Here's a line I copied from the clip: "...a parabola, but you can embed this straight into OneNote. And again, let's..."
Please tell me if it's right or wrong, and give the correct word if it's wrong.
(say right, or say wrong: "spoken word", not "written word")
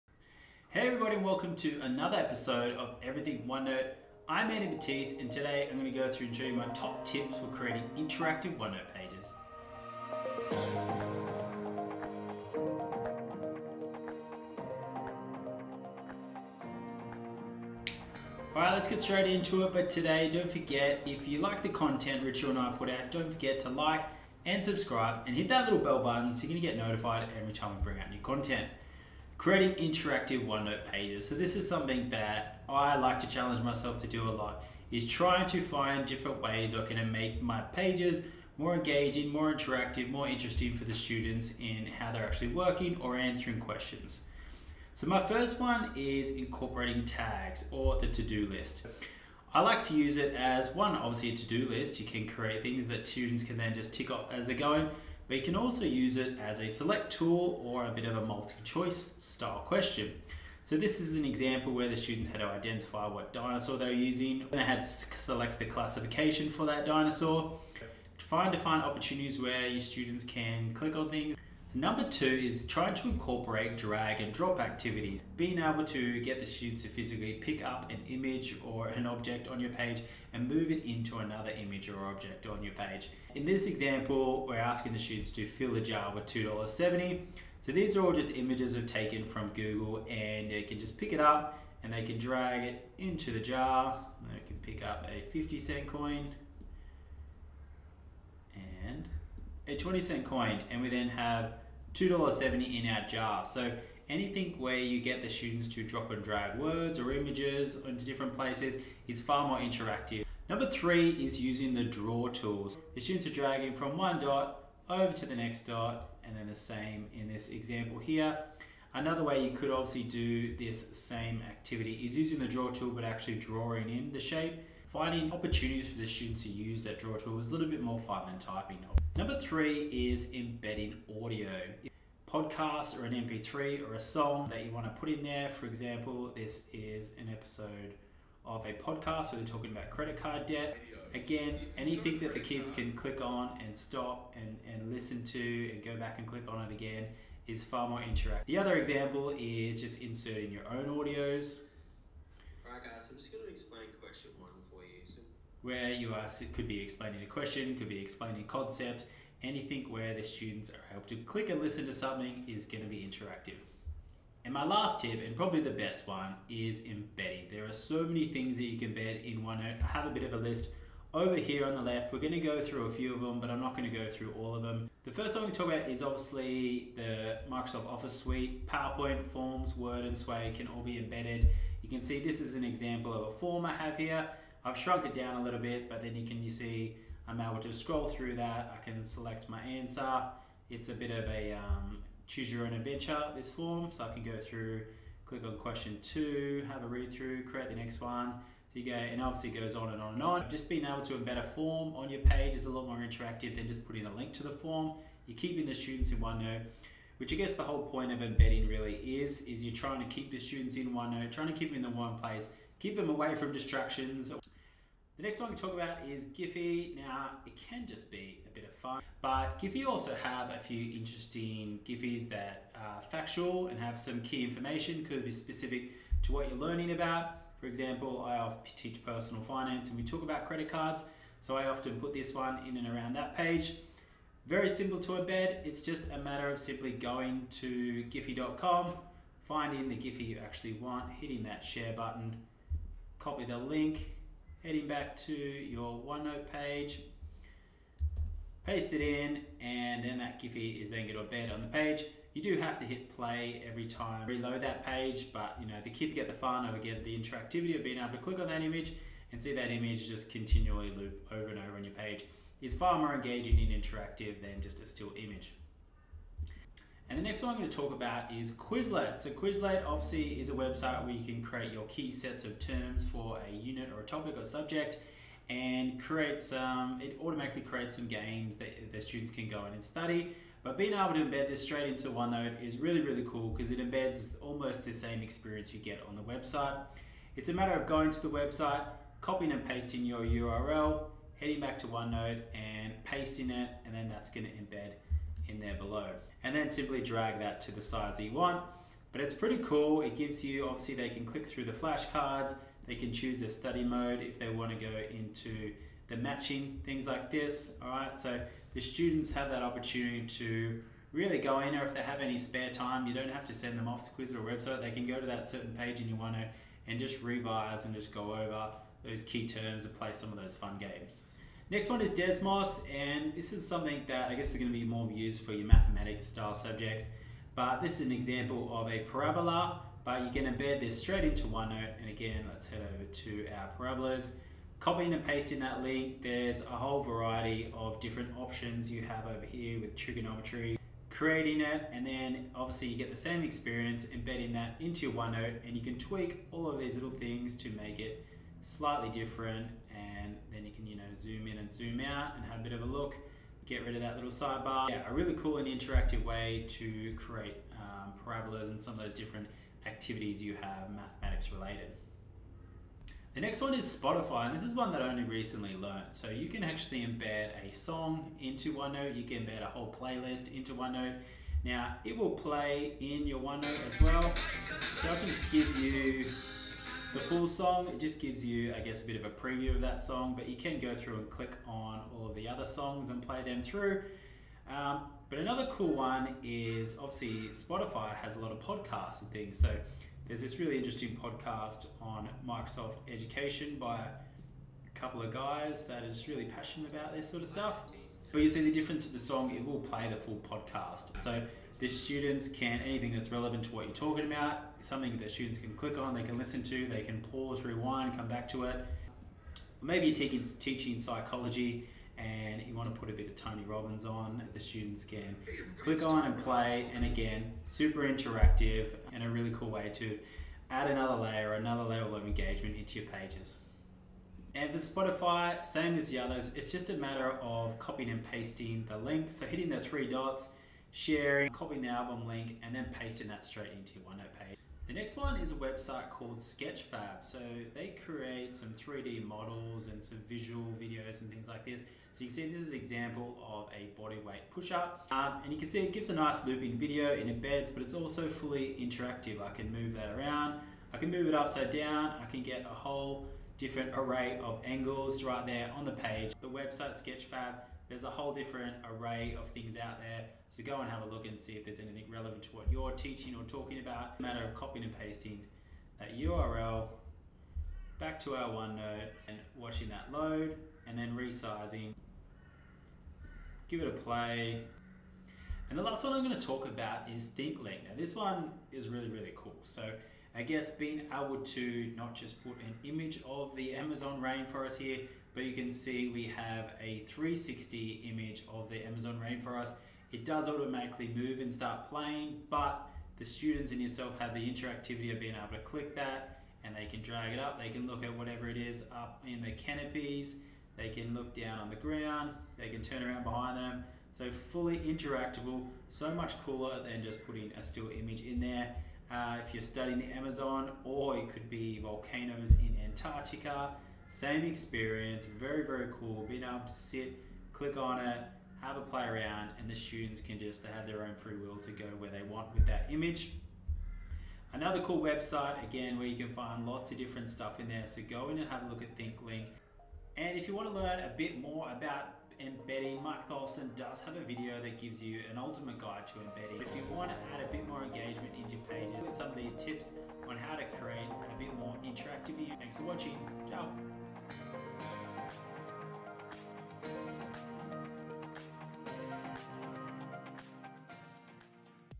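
right.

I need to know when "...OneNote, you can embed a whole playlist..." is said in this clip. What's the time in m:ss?
6:08.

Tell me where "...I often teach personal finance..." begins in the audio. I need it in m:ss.
3:48.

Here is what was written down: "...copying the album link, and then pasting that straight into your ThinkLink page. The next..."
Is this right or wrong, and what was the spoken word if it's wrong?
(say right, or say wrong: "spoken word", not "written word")
wrong: "OneNote", not "ThinkLink".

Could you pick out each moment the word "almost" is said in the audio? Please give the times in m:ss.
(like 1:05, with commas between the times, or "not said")
4:44.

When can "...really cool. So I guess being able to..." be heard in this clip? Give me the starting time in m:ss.
7:59.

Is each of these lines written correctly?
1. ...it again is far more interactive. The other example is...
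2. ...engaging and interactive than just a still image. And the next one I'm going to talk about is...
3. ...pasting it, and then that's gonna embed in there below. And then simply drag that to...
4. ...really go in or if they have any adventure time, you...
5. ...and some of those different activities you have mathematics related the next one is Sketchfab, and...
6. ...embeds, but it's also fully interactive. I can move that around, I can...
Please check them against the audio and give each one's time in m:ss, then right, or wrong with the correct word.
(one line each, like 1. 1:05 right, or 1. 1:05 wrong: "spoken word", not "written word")
1. 2:26 right
2. 4:23 right
3. 4:53 right
4. 5:11 wrong: "spare", not "adventure"
5. 5:58 wrong: "Spotify", not "Sketchfab"
6. 7:27 right.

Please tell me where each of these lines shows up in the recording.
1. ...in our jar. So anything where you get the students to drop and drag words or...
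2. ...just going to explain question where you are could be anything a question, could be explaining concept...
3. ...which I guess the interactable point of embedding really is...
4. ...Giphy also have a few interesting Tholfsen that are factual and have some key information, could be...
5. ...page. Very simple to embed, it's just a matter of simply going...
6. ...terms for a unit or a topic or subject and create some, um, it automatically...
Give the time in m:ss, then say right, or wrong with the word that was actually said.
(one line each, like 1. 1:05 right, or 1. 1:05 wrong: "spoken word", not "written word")
1. 1:42 right
2. 2:33 wrong: "explaining", not "anything"
3. 3:27 wrong: "whole", not "interactable"
4. 3:39 wrong: "Giphies", not "Tholfsen"
5. 3:53 right
6. 4:32 right.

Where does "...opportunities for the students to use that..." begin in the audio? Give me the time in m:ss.
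2:05.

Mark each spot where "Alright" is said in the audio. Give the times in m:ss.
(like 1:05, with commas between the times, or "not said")
0:18, 2:32.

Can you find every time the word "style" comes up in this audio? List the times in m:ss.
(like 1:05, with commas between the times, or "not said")
0:59, 5:26.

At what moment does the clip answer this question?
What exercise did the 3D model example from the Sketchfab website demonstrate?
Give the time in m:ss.
7:24.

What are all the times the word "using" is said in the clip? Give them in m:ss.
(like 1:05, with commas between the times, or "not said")
1:03, 1:51, 2:02.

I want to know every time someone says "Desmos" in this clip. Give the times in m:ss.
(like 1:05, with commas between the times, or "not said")
5:22.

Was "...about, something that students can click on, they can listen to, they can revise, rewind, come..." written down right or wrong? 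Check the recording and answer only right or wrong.
wrong.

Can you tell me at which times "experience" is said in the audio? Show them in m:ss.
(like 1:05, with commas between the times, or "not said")
4:45, 5:43, 8:34.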